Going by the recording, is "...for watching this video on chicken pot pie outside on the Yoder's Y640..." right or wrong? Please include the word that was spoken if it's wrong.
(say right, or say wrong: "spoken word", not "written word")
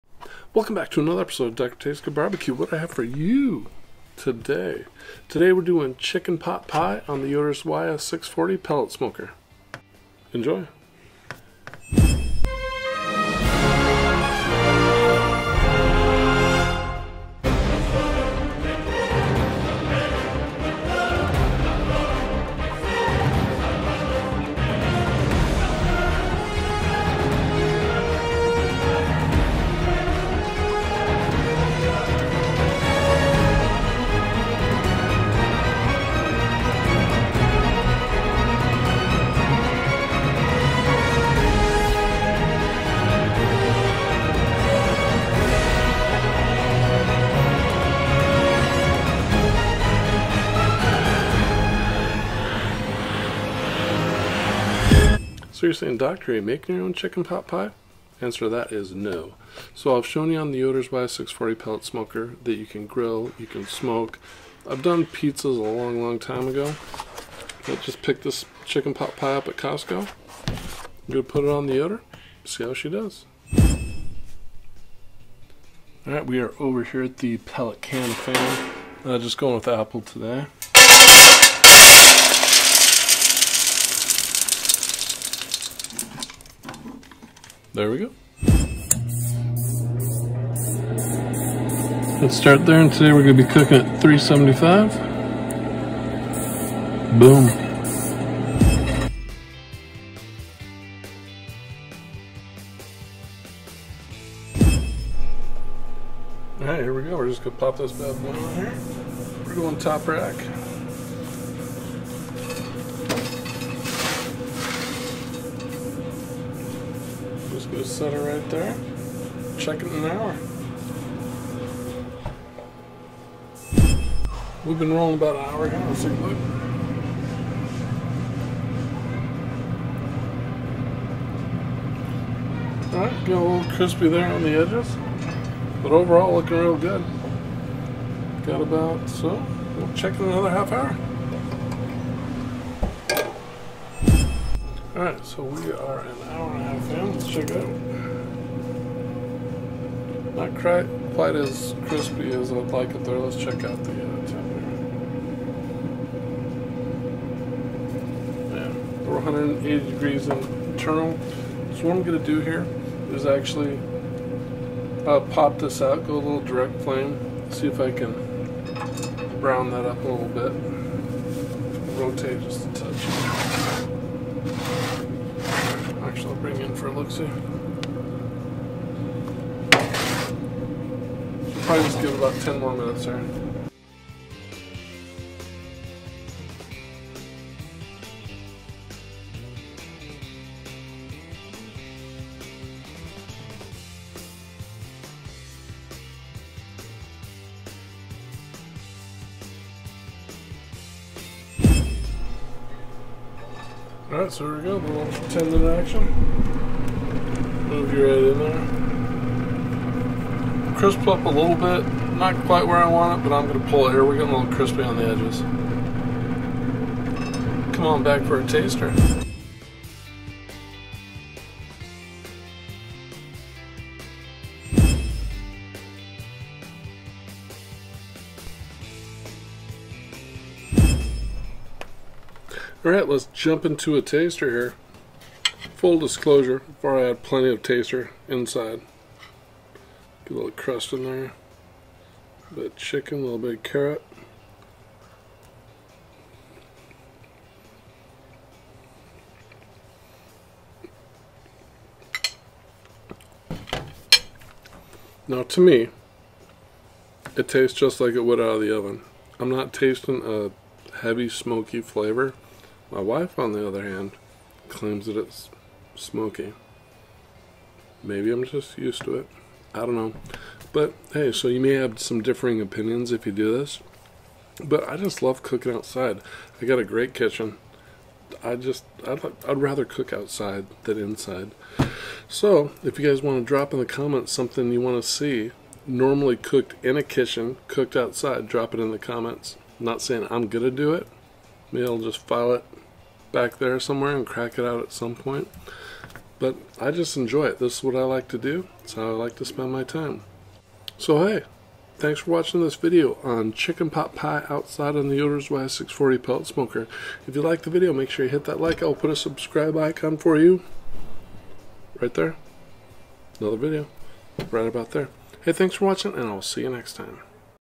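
right.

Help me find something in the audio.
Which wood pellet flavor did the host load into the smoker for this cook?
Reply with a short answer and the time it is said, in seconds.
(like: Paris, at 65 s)
Apple, at 79 s.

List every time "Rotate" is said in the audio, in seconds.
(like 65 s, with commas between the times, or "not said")
171 s.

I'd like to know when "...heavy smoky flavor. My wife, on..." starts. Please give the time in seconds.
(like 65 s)
261 s.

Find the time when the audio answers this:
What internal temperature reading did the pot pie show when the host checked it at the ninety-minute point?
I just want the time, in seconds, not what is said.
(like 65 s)
159 s.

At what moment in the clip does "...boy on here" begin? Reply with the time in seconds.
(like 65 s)
108 s.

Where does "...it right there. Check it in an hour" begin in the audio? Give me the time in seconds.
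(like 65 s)
118 s.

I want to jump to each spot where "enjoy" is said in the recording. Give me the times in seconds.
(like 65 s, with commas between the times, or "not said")
10 s, 297 s.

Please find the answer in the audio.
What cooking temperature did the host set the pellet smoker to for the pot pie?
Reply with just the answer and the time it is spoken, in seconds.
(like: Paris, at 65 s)
375, at 94 s.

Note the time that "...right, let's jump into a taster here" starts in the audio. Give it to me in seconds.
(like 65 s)
232 s.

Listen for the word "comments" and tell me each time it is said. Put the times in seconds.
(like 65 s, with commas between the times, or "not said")
283 s, 288 s.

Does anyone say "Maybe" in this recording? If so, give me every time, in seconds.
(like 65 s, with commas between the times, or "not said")
268 s, 291 s.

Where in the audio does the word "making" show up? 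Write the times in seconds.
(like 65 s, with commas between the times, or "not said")
56 s.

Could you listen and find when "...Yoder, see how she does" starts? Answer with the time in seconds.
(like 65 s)
71 s.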